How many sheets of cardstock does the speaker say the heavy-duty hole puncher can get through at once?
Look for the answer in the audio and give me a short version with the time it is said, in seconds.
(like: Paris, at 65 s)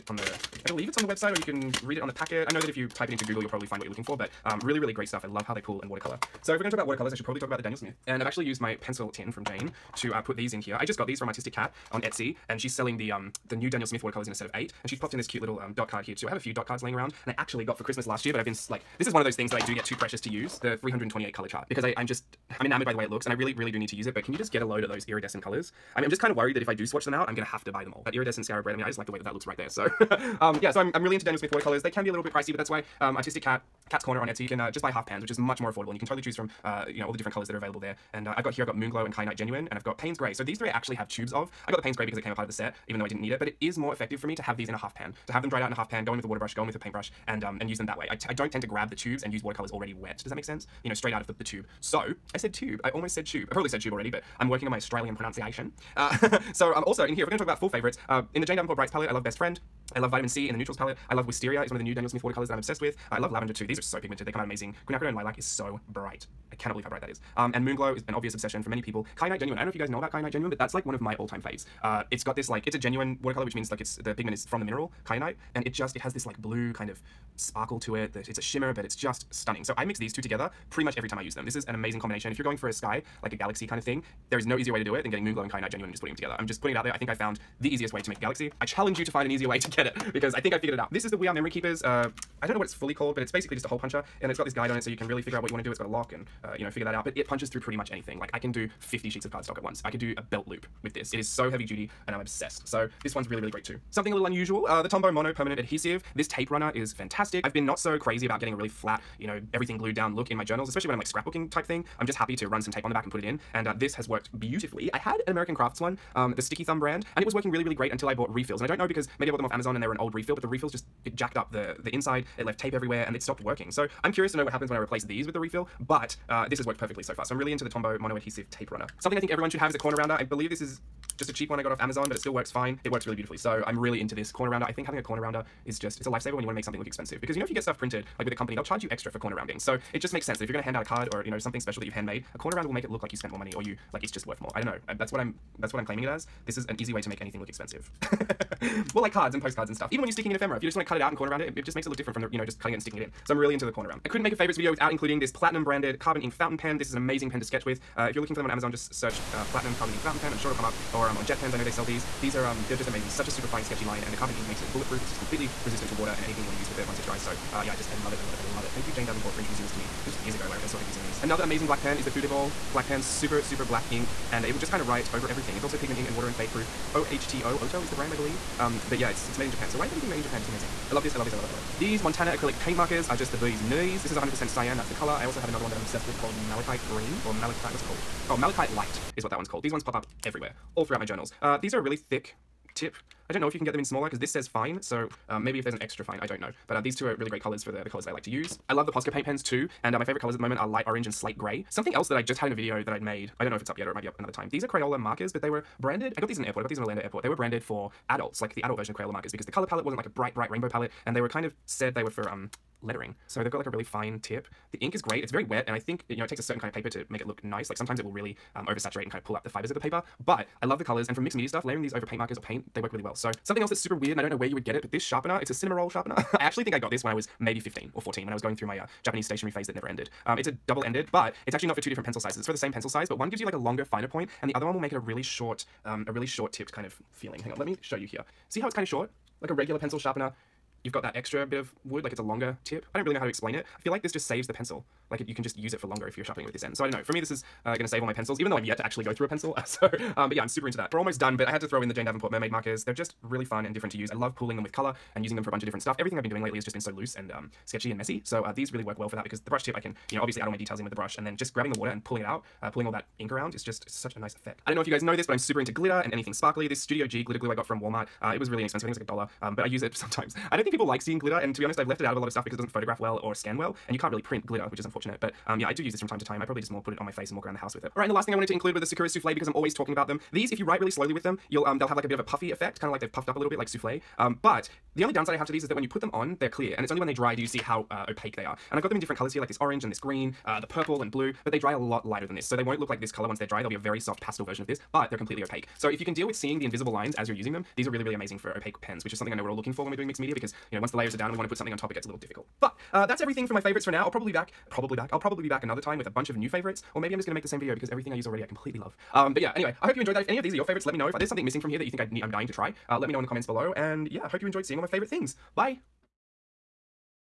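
50, at 98 s.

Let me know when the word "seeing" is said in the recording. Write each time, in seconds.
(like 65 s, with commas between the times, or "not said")
271 s, 296 s, 314 s.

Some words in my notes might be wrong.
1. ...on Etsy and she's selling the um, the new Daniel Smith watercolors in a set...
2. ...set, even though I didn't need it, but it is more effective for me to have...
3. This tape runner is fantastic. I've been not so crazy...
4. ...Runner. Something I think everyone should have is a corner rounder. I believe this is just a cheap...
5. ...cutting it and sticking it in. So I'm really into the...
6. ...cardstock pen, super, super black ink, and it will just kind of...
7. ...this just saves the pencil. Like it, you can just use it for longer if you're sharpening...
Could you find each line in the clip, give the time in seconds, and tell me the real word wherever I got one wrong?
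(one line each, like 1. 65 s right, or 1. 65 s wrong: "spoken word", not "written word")
1. 11 s right
2. 42 s right
3. 106 s right
4. 128 s right
5. 152 s right
6. 172 s wrong: "black", not "cardstock"
7. 244 s right.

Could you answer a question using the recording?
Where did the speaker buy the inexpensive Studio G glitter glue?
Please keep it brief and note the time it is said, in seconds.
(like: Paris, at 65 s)
Walmart, at 267 s.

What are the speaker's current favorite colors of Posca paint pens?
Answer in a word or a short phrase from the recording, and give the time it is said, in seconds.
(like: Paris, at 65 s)
light orange and slate gray, at 200 s.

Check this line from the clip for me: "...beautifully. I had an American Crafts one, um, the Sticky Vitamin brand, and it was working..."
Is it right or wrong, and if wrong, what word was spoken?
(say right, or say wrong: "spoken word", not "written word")
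wrong: "Thumb", not "Vitamin".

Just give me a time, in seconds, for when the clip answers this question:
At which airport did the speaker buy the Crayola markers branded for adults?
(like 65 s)
206 s.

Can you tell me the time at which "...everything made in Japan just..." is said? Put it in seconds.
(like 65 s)
179 s.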